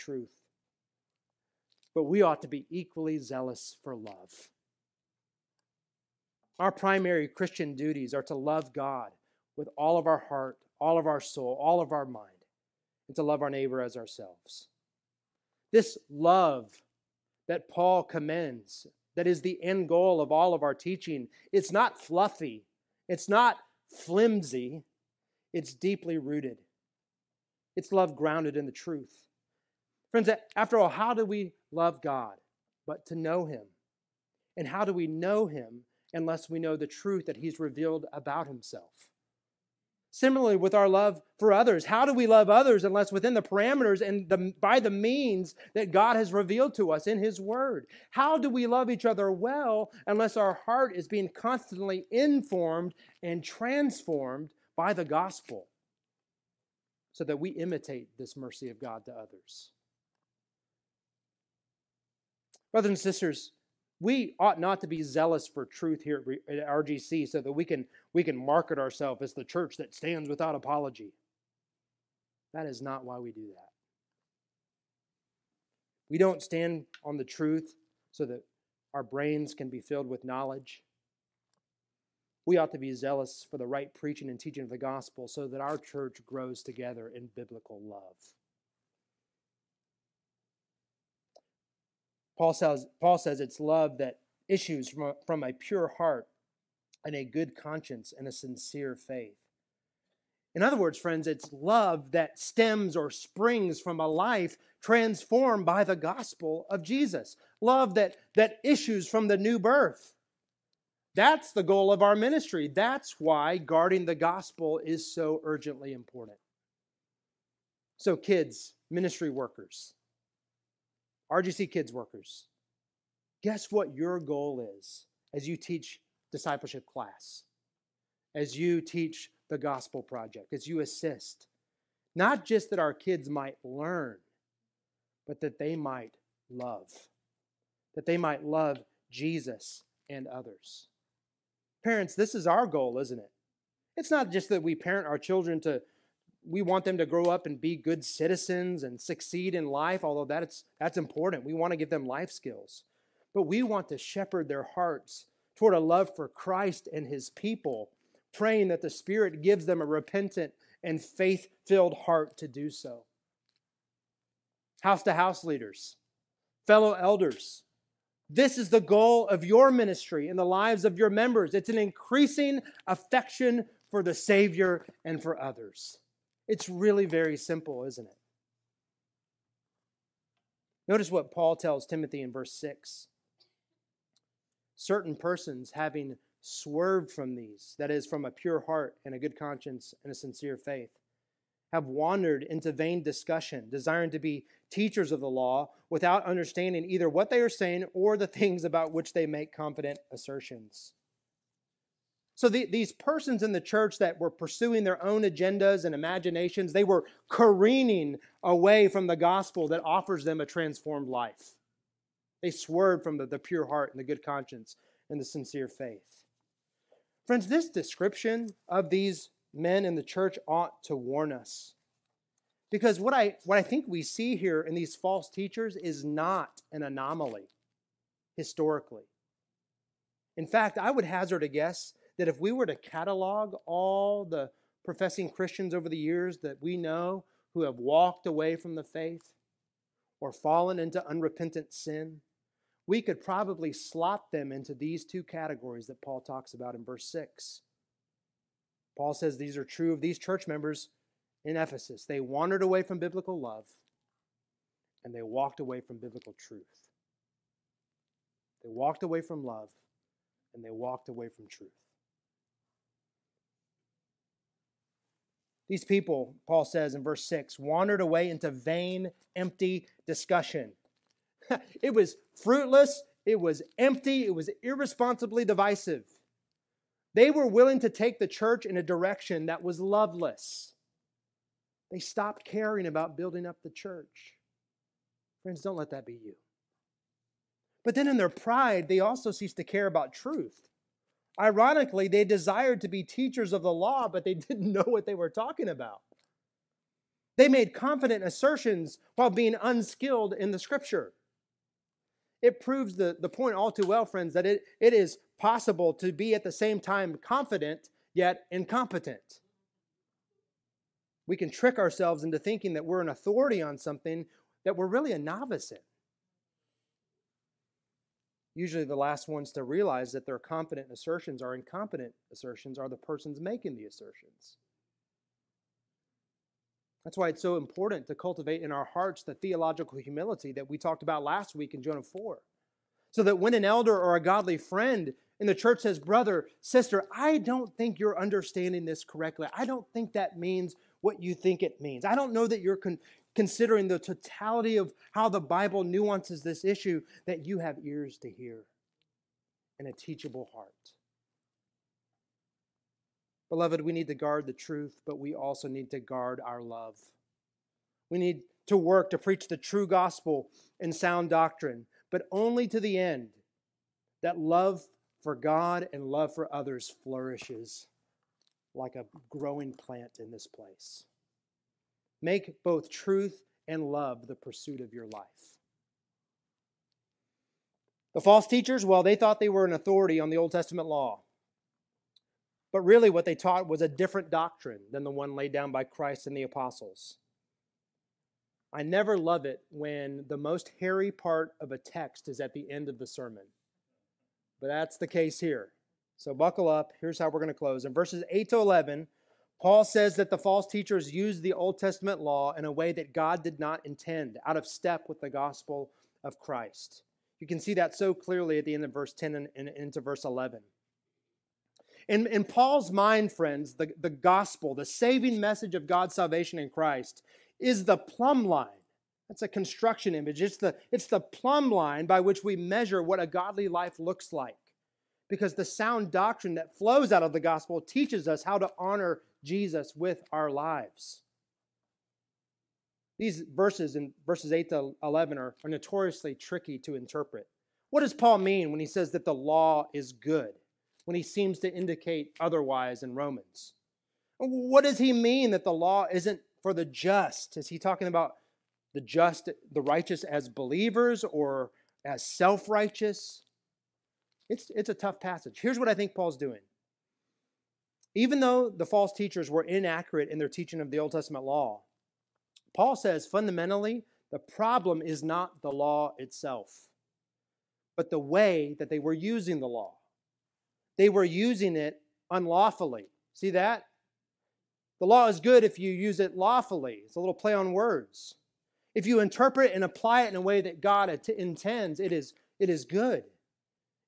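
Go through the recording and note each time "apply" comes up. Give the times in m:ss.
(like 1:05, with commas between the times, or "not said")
7:59.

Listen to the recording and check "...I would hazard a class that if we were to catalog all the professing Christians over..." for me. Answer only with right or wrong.
wrong.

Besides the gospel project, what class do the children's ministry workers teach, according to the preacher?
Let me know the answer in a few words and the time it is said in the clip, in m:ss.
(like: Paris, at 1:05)
discipleship class, at 2:06.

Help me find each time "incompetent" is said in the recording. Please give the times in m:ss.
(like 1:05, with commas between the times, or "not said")
5:08, 5:21.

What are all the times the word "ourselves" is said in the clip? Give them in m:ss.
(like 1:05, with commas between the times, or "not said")
0:13, 1:08, 5:11.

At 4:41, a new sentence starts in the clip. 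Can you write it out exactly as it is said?
They stopped caring about building up the church.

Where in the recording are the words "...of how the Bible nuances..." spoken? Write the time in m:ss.
5:44.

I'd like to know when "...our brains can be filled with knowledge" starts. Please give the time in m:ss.
1:18.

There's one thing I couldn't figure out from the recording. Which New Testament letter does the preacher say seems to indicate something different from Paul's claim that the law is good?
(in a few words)
Romans.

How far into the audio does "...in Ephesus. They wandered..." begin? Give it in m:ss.
4:11.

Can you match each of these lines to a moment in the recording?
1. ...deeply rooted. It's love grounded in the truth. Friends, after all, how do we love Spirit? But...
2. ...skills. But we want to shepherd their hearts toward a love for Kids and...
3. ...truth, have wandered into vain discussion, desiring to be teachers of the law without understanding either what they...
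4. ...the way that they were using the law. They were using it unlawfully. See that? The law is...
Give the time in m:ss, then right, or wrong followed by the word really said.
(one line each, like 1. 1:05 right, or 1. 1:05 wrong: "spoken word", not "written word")
1. 0:25 wrong: "God", not "Spirit"
2. 2:32 wrong: "Christ", not "Kids"
3. 3:10 wrong: "faith", not "truth"
4. 7:48 right.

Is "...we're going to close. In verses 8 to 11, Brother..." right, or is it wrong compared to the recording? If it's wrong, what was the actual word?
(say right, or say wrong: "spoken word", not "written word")
wrong: "Paul", not "Brother".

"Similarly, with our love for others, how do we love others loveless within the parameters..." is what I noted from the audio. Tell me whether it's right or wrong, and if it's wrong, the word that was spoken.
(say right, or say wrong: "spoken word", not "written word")
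wrong: "unless", not "loveless".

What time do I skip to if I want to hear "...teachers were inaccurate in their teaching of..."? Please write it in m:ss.
7:39.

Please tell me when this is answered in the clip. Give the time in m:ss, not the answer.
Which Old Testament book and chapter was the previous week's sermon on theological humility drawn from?
5:31.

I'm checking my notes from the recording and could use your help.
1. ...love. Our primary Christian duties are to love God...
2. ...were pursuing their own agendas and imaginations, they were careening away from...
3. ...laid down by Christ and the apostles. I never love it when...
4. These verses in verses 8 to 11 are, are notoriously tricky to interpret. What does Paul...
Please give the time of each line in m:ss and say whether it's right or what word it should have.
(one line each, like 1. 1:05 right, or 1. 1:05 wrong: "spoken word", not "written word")
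1. 0:03 right
2. 3:24 right
3. 6:25 right
4. 7:13 right.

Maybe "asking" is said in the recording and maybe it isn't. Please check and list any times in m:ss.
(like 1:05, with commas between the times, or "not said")
not said.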